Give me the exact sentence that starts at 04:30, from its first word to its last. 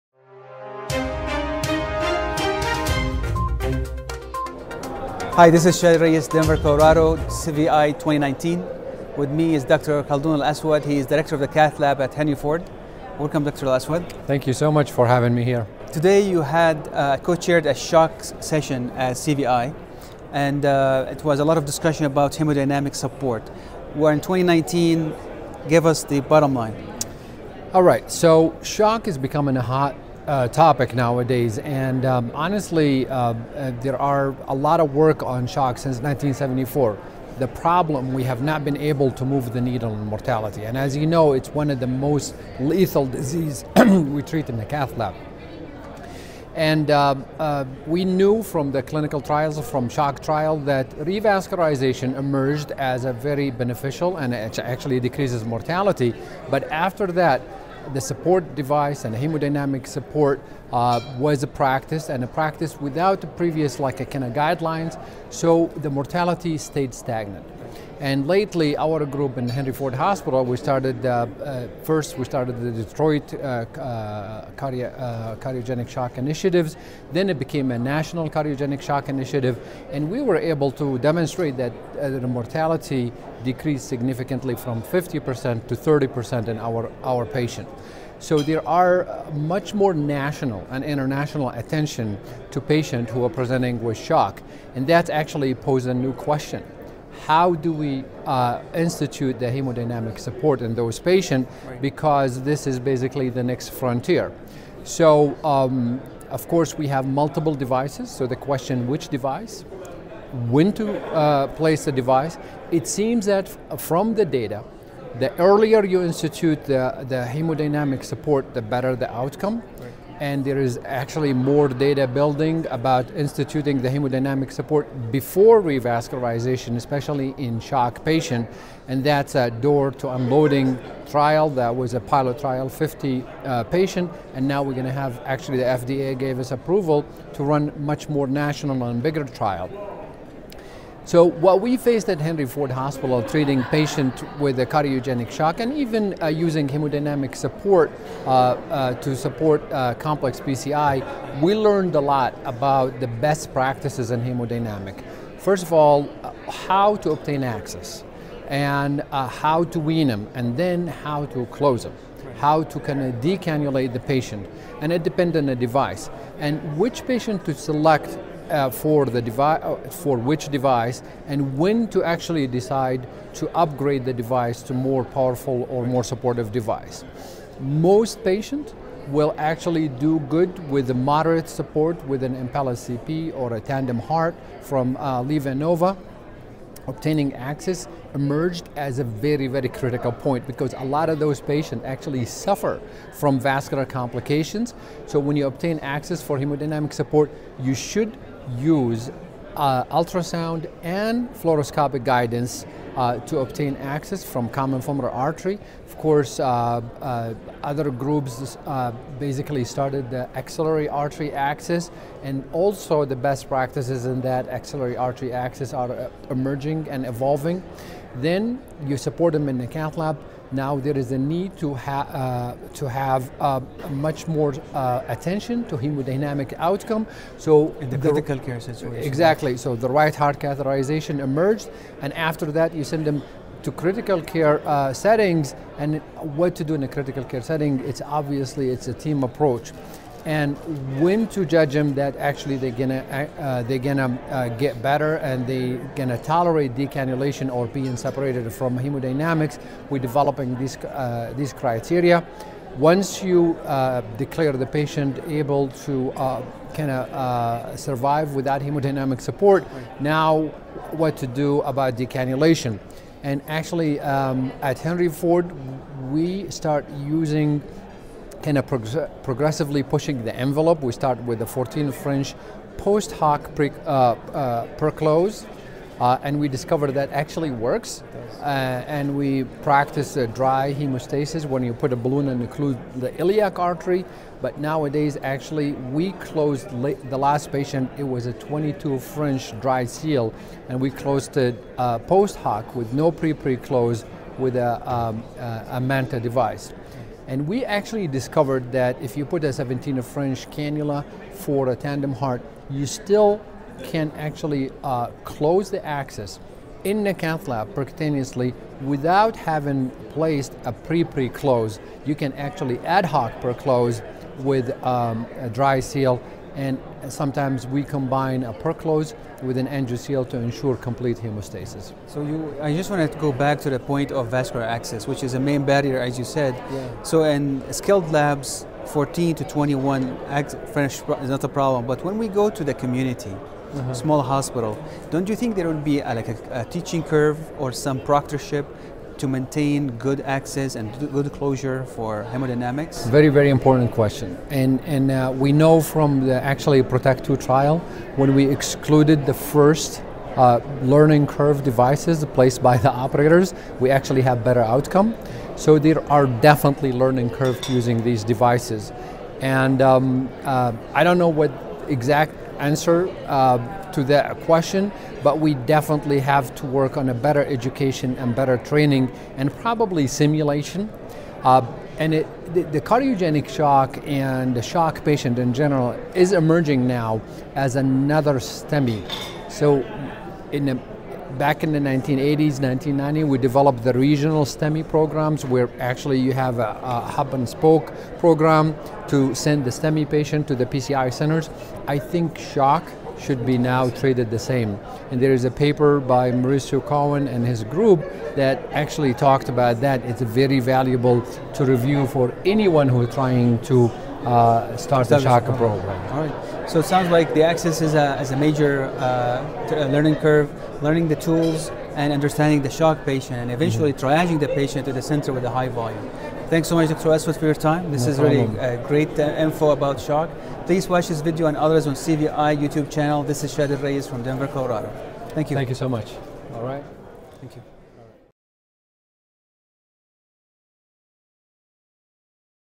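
We start with the 14 French post hoc pre, uh, uh, uh, and we discovered that actually works.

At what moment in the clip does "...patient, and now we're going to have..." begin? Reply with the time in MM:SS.
02:13.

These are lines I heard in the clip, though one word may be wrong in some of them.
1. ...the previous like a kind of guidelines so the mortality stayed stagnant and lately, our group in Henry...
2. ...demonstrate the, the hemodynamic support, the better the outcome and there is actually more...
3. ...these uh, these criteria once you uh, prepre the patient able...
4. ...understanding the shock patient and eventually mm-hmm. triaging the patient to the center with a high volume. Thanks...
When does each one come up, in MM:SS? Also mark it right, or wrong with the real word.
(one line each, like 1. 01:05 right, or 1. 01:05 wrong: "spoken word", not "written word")
1. 01:03 right
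2. 01:56 wrong: "institute", not "demonstrate"
3. 04:10 wrong: "declare", not "prepre"
4. 06:52 right.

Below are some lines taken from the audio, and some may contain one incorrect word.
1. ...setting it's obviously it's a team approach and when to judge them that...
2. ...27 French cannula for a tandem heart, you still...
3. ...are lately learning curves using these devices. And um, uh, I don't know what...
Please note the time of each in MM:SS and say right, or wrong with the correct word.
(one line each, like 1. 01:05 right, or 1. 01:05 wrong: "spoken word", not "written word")
1. 03:57 right
2. 04:59 wrong: "17", not "27"
3. 05:56 wrong: "definitely", not "lately".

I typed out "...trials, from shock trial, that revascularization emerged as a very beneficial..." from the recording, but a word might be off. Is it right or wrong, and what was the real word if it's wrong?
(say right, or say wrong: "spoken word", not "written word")
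right.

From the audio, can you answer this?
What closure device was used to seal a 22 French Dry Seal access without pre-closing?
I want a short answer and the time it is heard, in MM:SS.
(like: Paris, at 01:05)
Manta, at 04:55.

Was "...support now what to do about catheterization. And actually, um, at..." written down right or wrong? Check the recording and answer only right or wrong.
wrong.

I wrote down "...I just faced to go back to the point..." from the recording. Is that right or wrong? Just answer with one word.
wrong.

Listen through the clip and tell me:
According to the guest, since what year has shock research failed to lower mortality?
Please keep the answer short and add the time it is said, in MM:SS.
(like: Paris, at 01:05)
1974, at 00:35.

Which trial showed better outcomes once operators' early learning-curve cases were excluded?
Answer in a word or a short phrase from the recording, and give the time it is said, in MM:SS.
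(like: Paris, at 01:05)
PROTECT 2, at 05:46.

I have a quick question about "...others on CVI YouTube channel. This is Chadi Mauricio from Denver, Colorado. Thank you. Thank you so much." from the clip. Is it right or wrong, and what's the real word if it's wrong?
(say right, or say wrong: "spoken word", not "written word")
wrong: "Alraies", not "Mauricio".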